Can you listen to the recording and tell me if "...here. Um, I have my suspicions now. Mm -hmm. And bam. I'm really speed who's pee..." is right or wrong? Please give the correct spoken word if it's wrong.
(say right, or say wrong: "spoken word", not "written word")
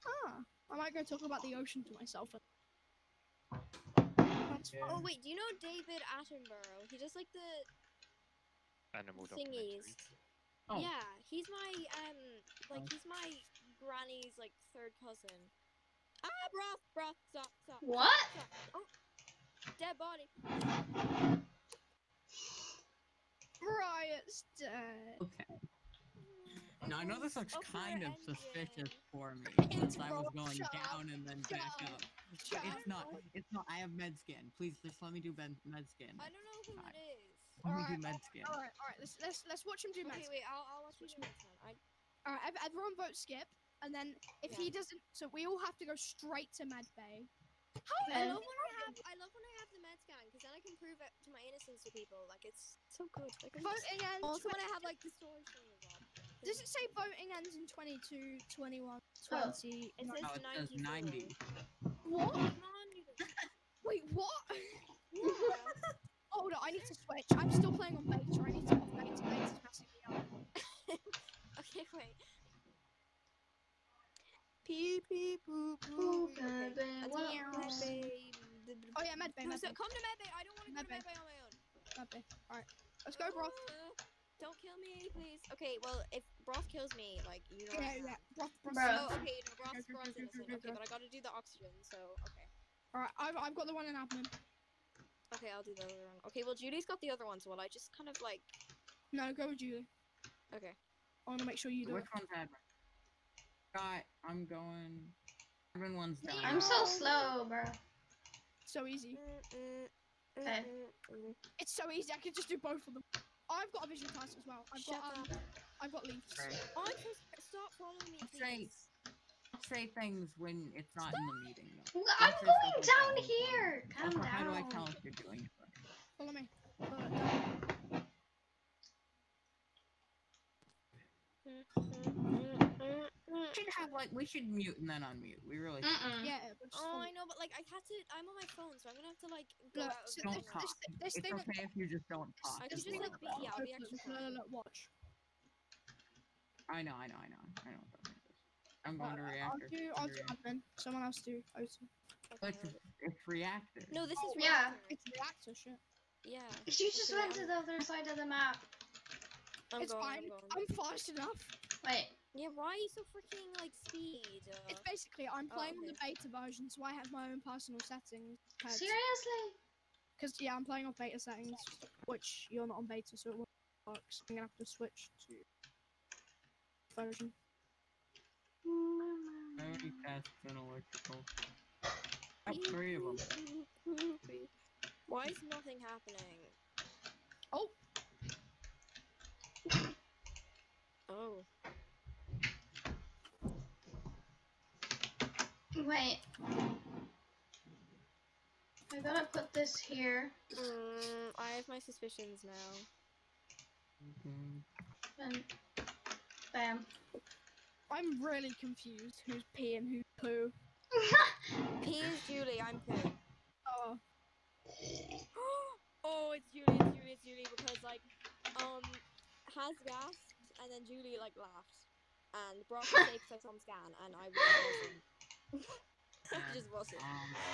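wrong: "confused", not "speed".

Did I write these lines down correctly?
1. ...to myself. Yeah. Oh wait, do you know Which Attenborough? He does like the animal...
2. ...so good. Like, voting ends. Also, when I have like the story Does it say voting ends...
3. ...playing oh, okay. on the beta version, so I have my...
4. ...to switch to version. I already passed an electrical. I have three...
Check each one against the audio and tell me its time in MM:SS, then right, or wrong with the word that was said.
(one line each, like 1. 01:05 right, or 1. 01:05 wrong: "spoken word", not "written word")
1. 00:01 wrong: "David", not "Which"
2. 00:52 right
3. 02:45 right
4. 02:54 right.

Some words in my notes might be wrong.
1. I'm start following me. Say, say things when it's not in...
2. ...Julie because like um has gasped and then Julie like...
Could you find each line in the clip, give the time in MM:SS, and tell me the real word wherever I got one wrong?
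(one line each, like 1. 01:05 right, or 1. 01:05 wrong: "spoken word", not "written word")
1. 01:56 right
2. 03:37 right.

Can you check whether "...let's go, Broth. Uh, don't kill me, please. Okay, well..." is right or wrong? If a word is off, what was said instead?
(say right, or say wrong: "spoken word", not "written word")
right.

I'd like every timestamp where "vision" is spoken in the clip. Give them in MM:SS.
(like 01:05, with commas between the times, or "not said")
01:53.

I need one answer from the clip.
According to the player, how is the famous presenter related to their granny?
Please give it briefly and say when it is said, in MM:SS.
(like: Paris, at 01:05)
third cousin, at 00:14.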